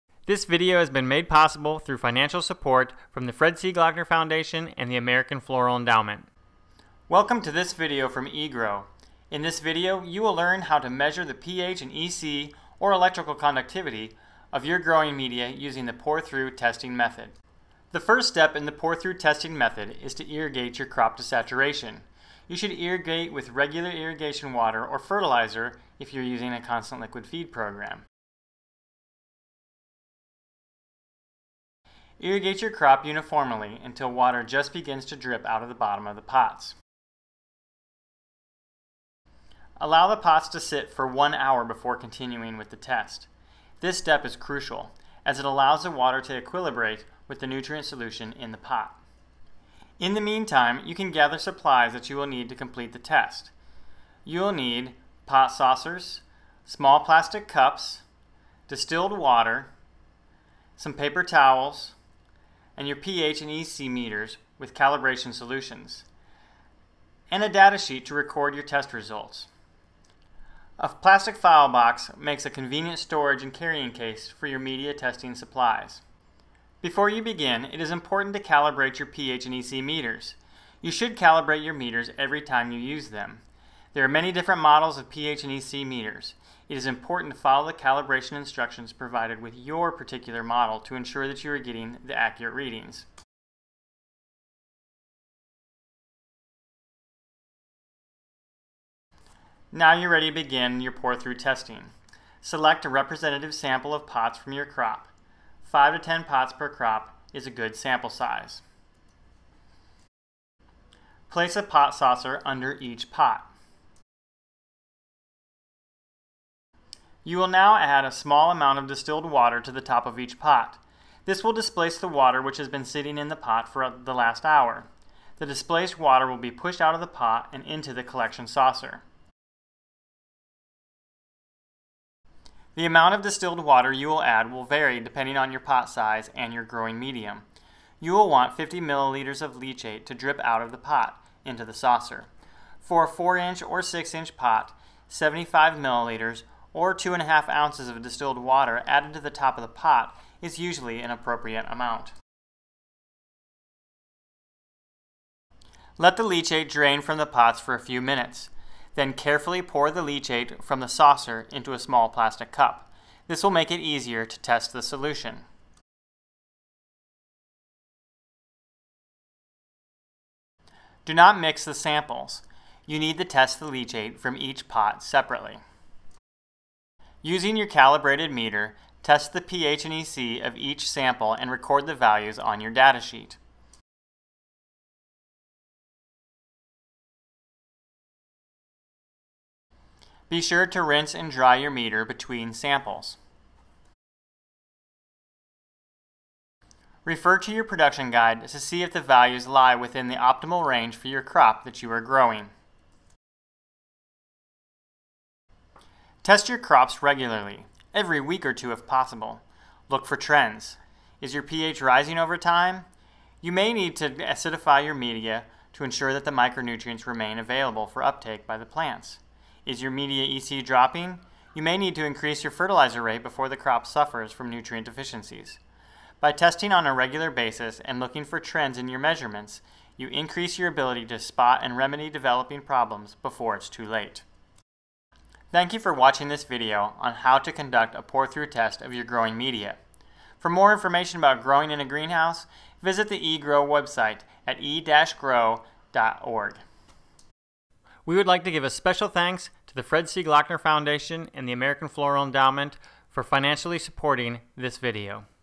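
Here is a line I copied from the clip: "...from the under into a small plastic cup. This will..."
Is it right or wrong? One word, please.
wrong.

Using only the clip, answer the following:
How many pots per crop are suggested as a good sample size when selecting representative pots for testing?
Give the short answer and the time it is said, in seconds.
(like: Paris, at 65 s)
5 to 10, at 105 s.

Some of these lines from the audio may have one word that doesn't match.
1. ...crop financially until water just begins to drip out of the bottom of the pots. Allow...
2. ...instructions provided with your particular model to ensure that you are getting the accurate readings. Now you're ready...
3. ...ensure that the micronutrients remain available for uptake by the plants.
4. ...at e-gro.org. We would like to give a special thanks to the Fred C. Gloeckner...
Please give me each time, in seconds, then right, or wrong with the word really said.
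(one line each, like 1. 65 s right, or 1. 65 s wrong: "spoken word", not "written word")
1. 32 s wrong: "uniformly", not "financially"
2. 88 s right
3. 215 s right
4. 244 s right.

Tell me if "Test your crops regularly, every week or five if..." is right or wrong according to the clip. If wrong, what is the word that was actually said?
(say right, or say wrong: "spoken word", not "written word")
wrong: "two", not "five".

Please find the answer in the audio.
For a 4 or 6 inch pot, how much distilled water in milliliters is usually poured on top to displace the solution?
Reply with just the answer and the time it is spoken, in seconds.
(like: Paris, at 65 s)
75 milliliters, at 145 s.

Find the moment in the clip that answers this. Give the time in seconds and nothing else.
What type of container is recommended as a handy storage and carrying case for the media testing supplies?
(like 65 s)
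70 s.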